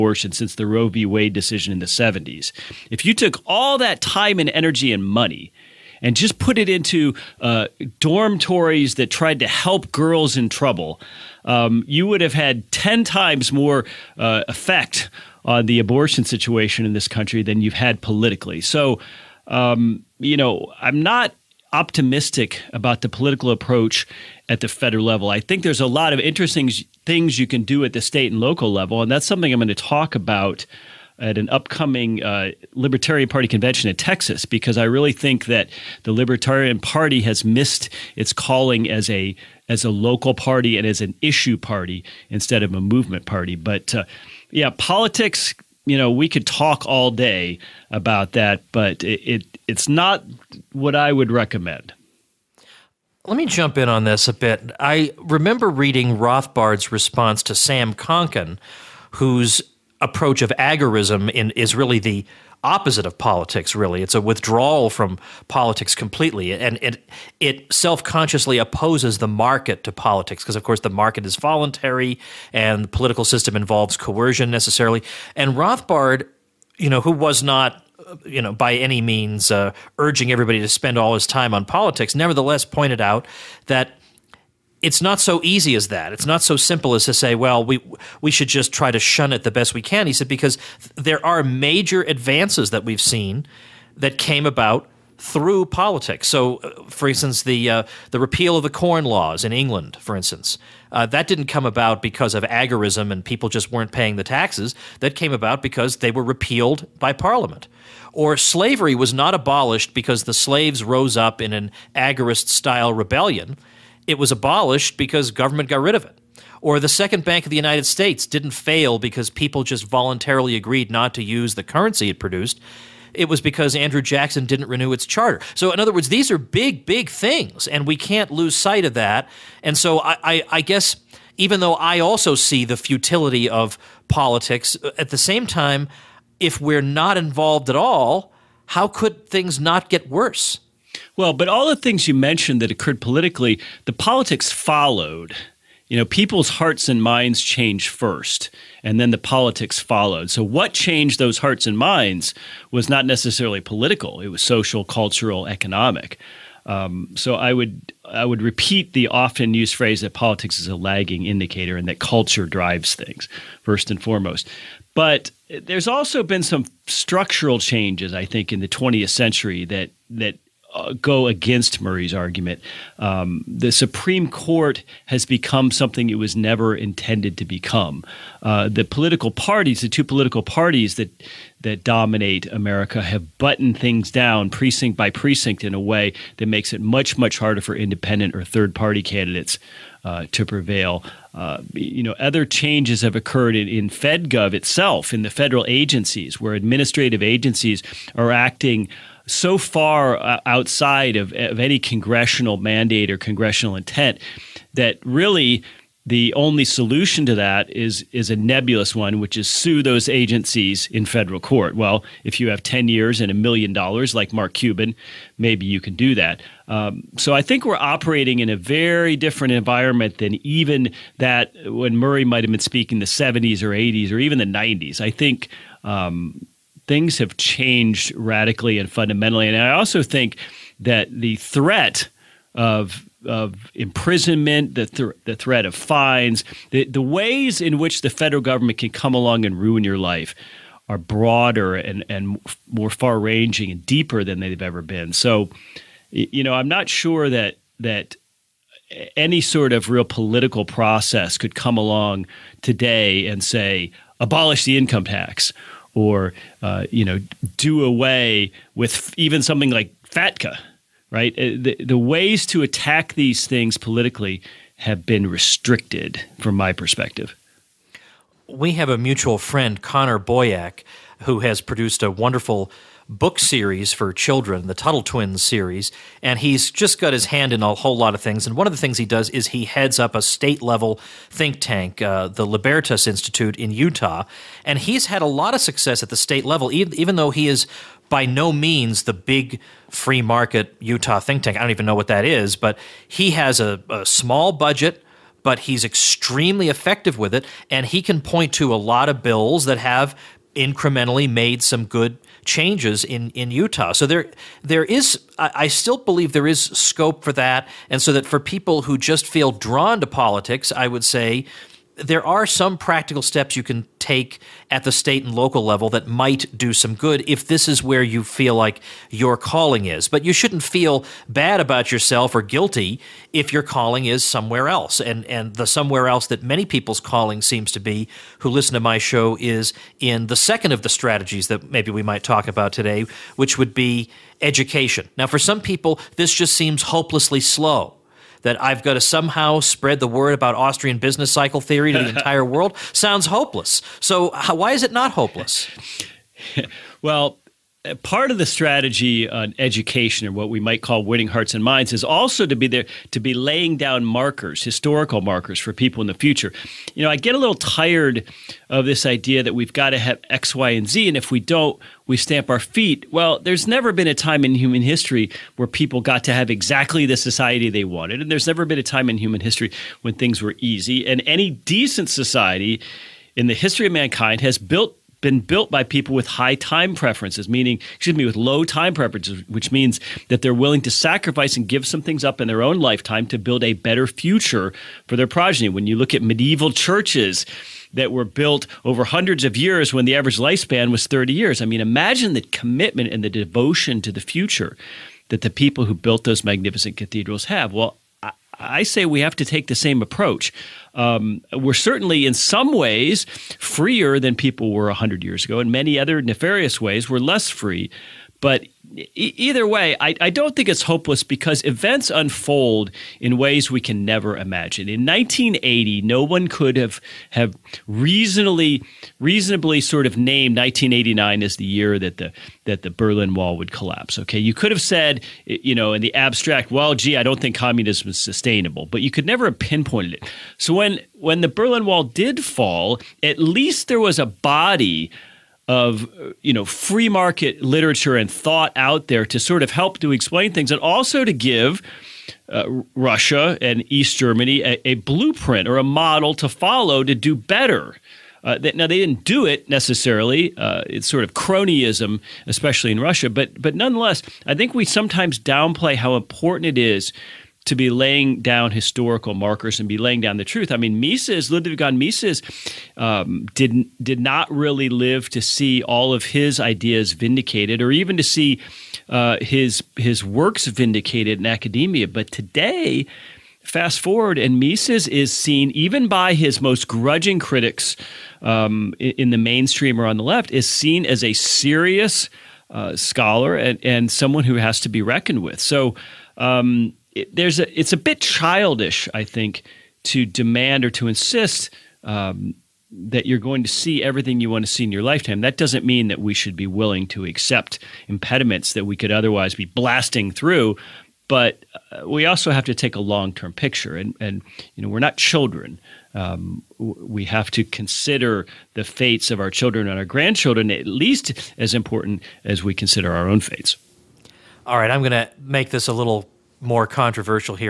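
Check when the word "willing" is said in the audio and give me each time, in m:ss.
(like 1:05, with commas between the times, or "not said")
6:20, 8:16.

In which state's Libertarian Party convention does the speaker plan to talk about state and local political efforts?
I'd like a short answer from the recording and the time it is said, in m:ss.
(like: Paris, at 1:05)
Texas, at 0:33.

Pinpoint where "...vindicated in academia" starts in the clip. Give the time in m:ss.
7:50.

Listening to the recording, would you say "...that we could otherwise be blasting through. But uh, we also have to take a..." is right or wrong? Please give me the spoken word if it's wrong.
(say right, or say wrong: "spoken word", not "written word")
right.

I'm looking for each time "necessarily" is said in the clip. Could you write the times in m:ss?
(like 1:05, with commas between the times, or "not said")
1:14, 2:33, 7:29.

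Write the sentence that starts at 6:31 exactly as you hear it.
I mean, imagine the commitment and the devotion to the future that the people who built those magnificent cathedrals have.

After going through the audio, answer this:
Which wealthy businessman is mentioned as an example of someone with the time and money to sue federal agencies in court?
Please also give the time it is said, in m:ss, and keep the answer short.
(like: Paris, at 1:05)
Mark Cuban, at 3:34.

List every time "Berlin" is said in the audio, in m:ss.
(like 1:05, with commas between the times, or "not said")
7:02, 7:11.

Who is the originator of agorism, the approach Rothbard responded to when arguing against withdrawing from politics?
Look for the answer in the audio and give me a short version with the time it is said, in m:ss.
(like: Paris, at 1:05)
Sam Konkin, at 0:57.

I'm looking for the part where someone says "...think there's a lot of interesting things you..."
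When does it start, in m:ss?
0:25.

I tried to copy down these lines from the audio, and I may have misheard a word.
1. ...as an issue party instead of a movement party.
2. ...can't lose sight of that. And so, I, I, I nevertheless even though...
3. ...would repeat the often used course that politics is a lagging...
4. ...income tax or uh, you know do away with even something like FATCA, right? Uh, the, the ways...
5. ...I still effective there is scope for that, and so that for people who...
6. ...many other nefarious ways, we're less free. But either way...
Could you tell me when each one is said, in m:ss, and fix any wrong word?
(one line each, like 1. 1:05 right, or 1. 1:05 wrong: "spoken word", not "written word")
1. 0:40 right
2. 2:07 wrong: "guess", not "nevertheless"
3. 2:38 wrong: "phrase", not "course"
4. 4:14 right
5. 5:05 wrong: "believe", not "effective"
6. 6:45 right.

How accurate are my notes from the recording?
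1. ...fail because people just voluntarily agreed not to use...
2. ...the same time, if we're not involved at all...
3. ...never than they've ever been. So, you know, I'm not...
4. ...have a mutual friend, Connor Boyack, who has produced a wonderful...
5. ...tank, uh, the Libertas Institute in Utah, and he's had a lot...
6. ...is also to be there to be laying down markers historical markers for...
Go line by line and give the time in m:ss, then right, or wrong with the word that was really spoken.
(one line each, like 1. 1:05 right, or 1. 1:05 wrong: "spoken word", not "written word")
1. 1:58 right
2. 2:15 right
3. 4:03 wrong: "deeper", not "never"
4. 4:28 right
5. 4:41 right
6. 5:51 right.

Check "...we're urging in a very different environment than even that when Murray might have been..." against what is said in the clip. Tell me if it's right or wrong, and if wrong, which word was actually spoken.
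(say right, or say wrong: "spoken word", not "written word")
wrong: "operating", not "urging".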